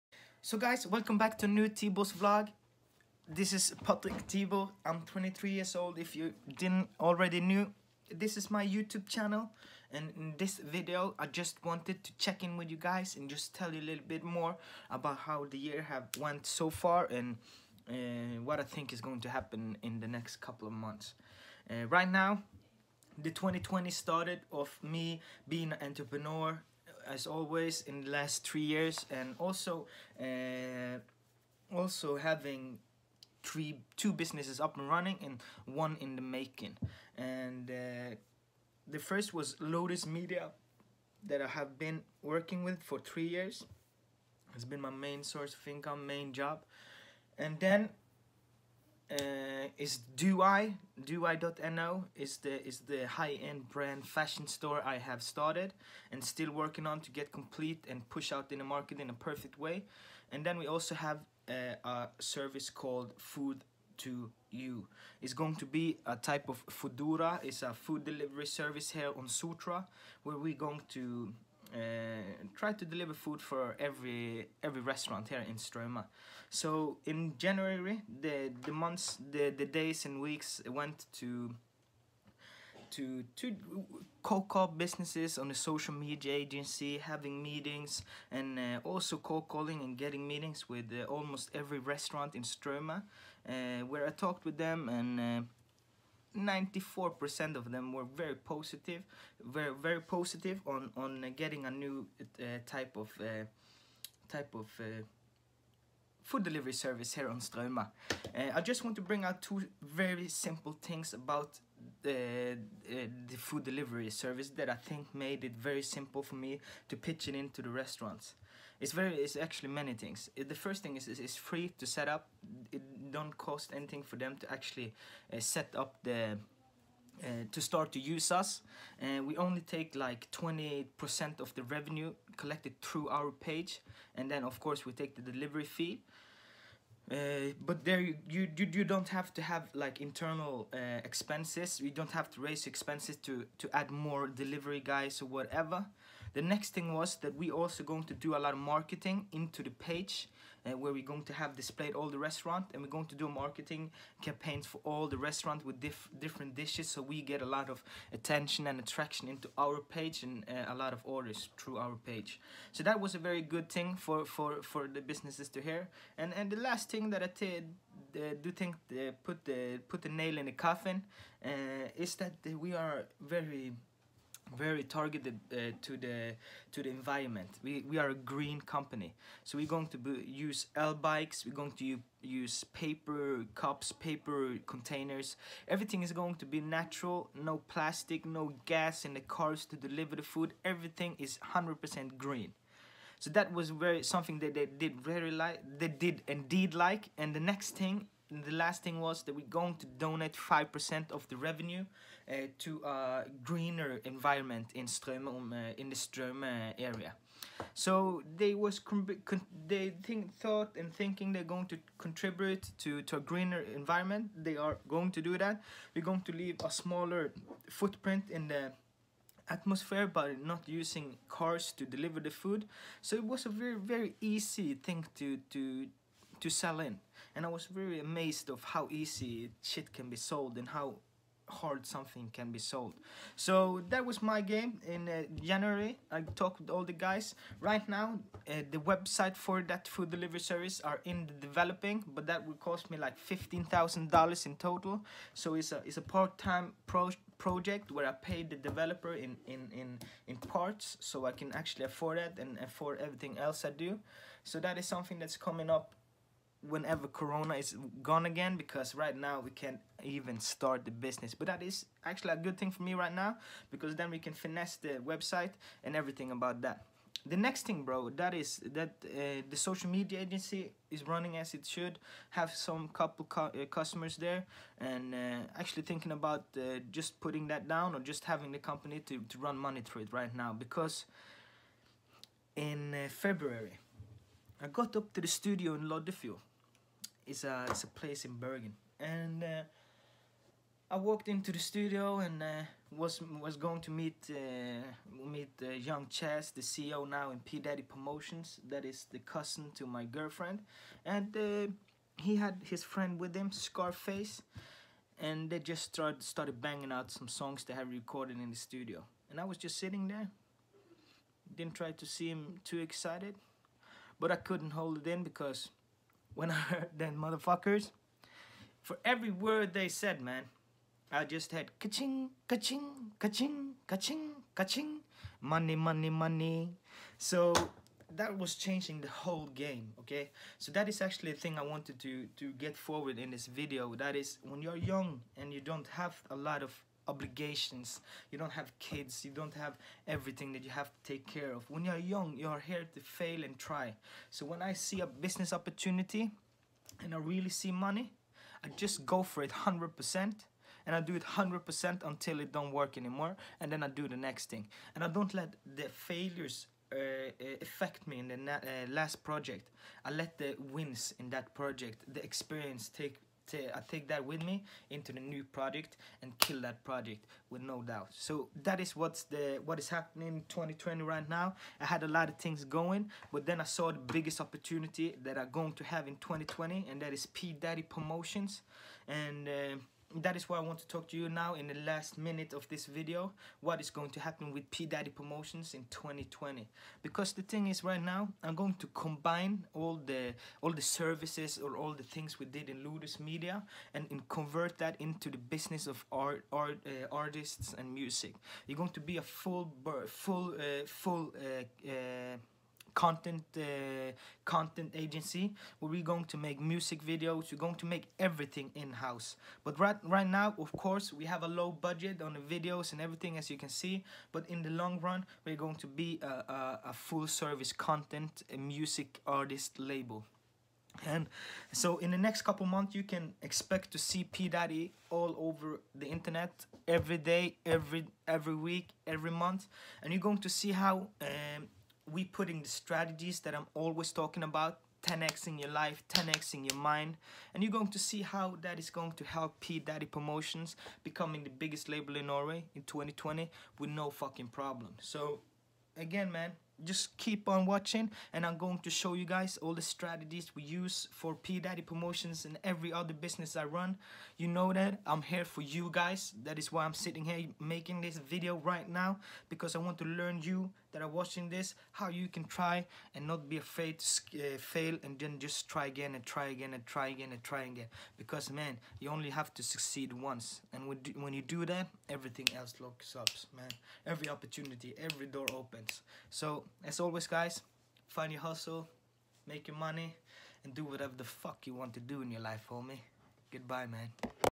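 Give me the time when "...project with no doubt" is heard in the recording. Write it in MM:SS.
06:06.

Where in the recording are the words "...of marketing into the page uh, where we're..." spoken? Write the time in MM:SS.
02:28.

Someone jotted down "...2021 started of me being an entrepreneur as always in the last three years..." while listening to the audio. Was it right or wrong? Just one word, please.
wrong.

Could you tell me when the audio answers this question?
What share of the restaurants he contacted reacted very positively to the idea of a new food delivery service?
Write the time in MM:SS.
01:36.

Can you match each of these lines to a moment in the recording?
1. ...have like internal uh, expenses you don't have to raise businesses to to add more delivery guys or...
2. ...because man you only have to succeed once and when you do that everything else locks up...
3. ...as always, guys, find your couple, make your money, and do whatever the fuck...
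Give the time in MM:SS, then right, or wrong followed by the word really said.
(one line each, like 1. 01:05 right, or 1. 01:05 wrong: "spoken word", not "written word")
1. 02:19 wrong: "expenses", not "businesses"
2. 07:48 right
3. 07:56 wrong: "hustle", not "couple".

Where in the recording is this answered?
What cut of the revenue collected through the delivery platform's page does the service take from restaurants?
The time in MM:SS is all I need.
02:10.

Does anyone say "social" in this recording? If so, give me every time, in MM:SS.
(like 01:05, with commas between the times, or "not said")
01:25, 04:29.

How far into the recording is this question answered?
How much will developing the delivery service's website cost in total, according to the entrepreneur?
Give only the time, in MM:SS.
04:03.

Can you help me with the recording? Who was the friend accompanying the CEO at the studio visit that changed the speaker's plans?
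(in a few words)
SkarFace.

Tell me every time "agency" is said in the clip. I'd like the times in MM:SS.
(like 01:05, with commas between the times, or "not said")
01:26, 04:30, 06:44.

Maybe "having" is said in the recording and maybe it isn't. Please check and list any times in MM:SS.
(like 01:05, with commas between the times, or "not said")
00:32, 01:26, 04:38.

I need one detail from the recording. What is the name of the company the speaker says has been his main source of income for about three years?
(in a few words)
Lotus Media.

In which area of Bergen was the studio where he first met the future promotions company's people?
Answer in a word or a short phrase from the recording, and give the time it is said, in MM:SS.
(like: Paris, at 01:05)
Loddefjord, at 04:45.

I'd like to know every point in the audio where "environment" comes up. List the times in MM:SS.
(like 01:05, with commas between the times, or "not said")
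02:56, 03:24, 03:33.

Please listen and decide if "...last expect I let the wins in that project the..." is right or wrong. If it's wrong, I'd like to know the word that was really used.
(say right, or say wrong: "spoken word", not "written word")
wrong: "project", not "expect".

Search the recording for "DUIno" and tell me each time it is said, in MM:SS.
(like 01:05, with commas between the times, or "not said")
00:51.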